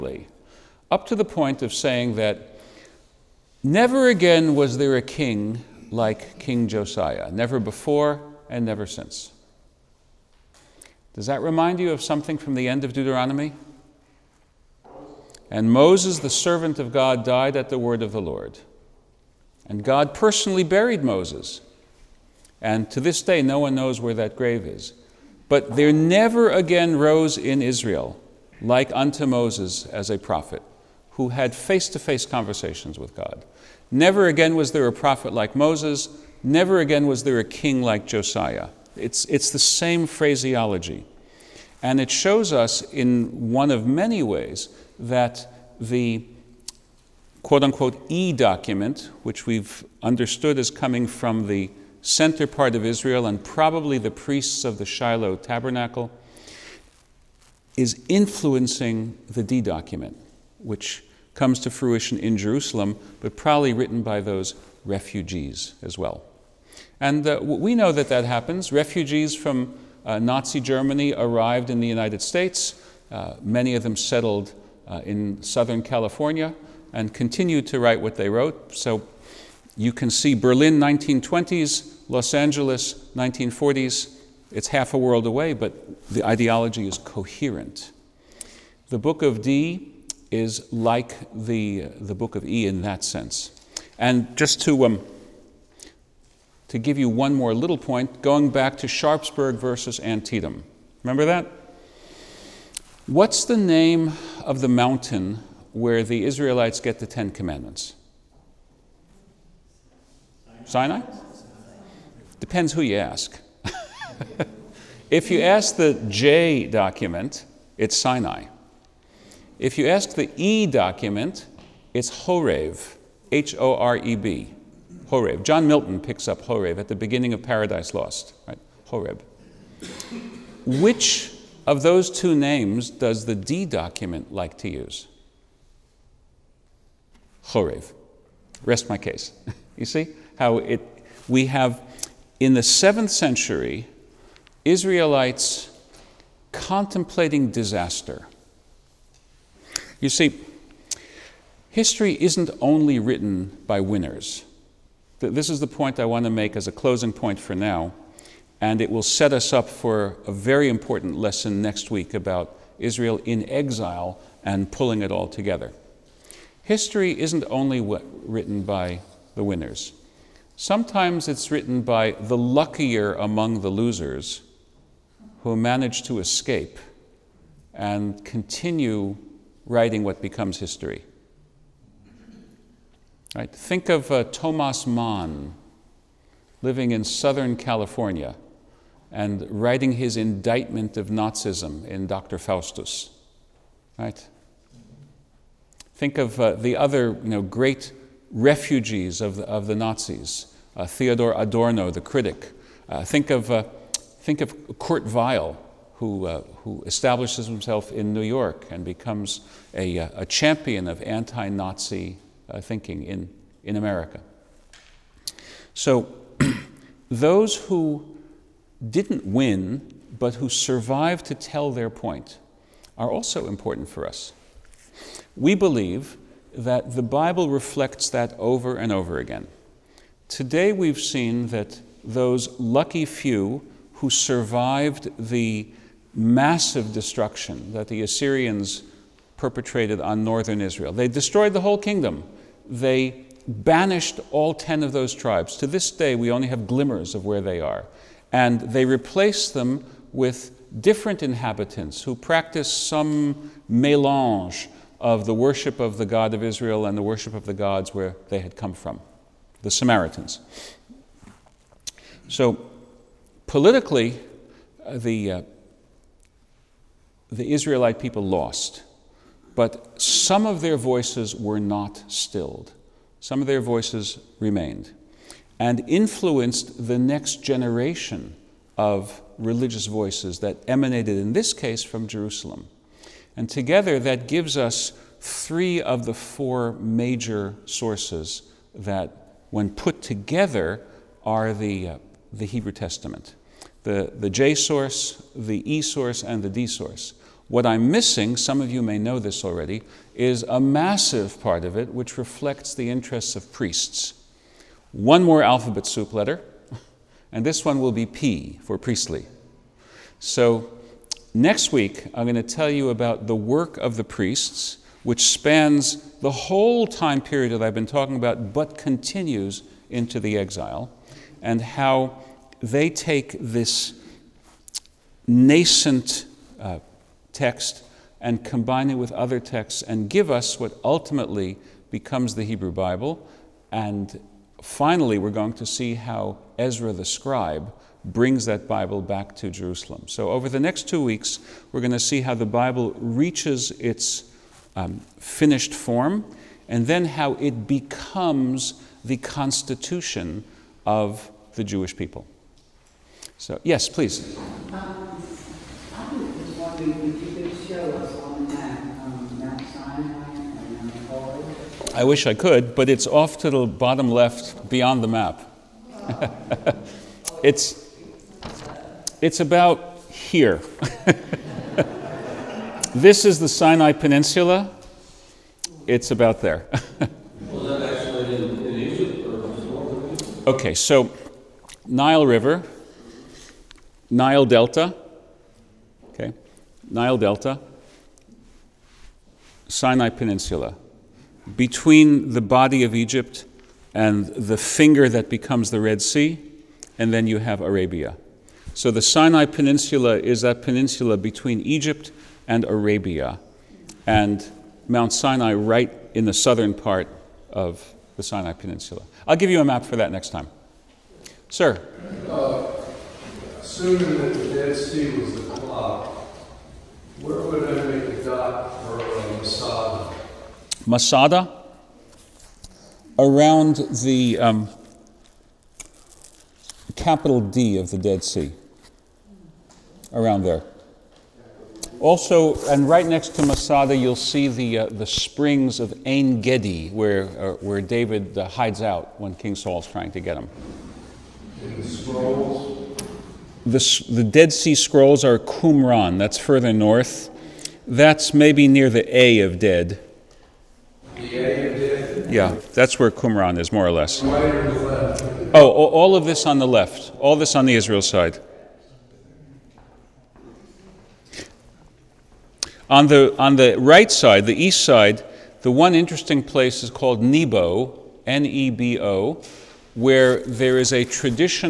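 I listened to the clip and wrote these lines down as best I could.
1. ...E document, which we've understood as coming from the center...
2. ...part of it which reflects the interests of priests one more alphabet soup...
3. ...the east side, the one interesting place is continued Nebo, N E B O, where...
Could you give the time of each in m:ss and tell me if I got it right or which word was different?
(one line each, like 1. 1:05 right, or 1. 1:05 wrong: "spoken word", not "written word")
1. 0:48 right
2. 5:01 right
3. 7:44 wrong: "called", not "continued".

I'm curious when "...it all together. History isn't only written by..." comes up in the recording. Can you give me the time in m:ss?
2:45.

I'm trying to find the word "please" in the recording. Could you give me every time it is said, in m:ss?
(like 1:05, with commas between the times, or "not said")
5:53.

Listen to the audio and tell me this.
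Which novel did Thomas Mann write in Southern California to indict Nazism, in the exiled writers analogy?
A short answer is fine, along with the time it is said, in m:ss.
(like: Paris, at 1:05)
Dr. Faustus, at 3:12.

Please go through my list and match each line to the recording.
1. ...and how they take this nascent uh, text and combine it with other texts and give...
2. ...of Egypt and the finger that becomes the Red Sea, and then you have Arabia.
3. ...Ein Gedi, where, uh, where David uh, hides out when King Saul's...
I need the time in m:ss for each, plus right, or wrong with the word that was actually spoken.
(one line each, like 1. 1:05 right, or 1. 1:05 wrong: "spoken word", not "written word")
1. 5:21 right
2. 6:32 right
3. 7:16 right.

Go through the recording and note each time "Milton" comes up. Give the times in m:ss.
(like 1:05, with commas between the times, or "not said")
2:05.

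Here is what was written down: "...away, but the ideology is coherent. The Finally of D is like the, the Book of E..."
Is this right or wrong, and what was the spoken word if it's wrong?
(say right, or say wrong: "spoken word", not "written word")
wrong: "Book", not "Finally".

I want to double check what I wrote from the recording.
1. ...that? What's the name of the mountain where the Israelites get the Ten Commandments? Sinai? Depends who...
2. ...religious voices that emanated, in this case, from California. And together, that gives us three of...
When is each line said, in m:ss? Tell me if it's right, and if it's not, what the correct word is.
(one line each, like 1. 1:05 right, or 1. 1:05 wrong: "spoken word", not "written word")
1. 1:41 right
2. 4:39 wrong: "Jerusalem", not "California".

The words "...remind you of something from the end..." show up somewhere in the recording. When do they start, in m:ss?
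0:11.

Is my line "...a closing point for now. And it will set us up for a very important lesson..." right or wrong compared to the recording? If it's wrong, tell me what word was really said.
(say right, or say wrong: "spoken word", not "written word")
right.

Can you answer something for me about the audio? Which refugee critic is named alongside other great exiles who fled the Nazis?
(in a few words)
Theodor Adorno.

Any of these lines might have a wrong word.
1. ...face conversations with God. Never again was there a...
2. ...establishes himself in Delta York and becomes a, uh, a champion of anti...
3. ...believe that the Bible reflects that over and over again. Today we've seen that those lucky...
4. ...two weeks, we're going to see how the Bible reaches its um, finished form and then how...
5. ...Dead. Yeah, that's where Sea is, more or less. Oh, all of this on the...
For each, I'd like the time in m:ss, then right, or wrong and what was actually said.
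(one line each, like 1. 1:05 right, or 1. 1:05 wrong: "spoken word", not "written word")
1. 0:31 right
2. 3:26 wrong: "New", not "Delta"
3. 3:45 right
4. 5:40 right
5. 7:29 wrong: "Qumran", not "Sea".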